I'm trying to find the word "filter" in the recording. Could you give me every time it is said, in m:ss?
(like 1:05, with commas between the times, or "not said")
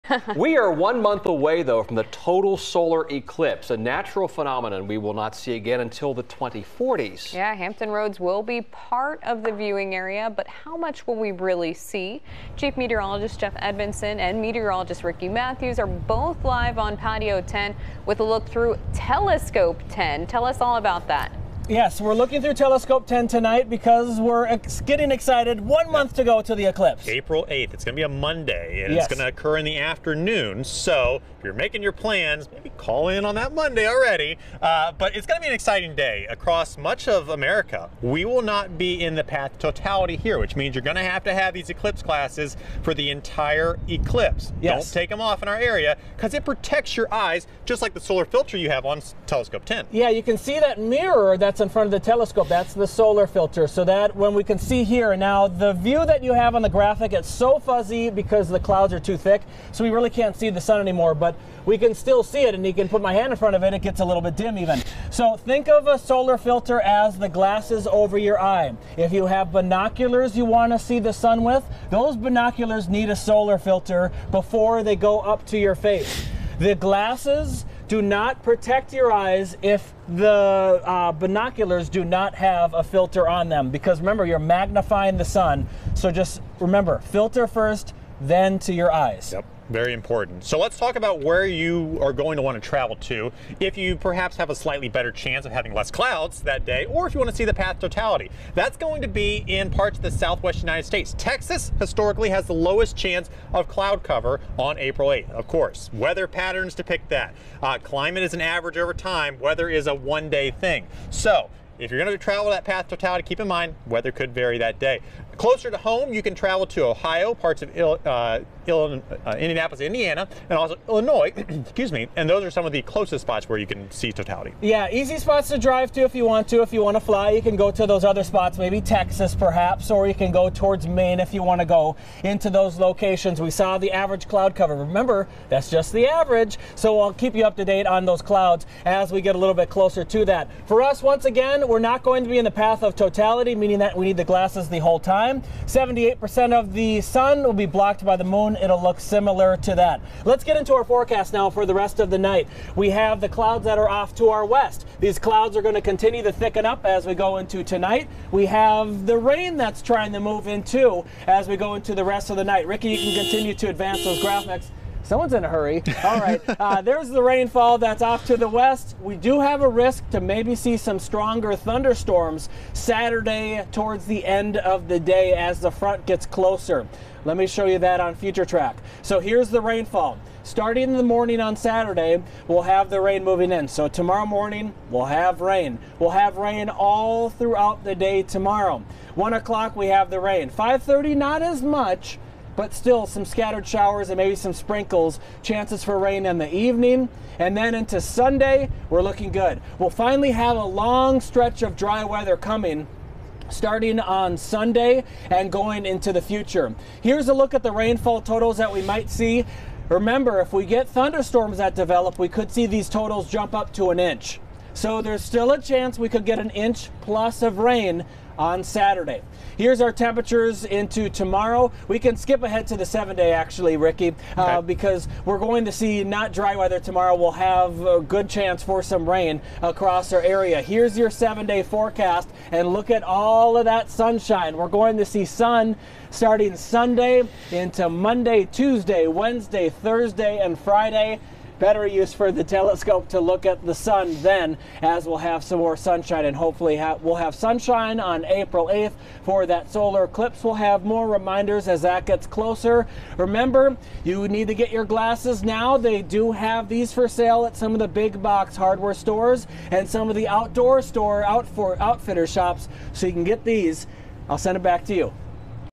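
0:48, 0:53, 1:06, 1:13, 1:22, 1:26.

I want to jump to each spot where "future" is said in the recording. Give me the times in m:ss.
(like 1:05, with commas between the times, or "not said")
2:58, 3:26.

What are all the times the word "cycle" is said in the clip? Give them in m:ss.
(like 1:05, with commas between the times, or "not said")
not said.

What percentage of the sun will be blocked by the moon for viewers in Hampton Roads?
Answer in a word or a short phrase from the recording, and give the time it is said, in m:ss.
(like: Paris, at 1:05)
78%, at 2:25.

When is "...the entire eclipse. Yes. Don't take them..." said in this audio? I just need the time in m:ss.
0:42.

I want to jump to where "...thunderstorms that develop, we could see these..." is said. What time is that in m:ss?
3:30.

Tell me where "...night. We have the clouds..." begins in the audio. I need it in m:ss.
2:32.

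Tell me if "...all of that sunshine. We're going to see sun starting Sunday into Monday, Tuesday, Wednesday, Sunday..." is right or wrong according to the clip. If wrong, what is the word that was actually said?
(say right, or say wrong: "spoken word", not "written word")
wrong: "Thursday", not "Sunday".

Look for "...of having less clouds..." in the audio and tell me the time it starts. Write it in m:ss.
1:35.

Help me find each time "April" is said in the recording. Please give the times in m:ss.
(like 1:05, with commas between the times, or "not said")
0:27, 1:44, 4:08.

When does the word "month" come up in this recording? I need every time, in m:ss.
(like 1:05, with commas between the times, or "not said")
0:01, 0:25.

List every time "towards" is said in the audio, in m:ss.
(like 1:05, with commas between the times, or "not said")
2:10, 2:53.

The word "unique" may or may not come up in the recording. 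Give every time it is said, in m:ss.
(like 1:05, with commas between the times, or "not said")
not said.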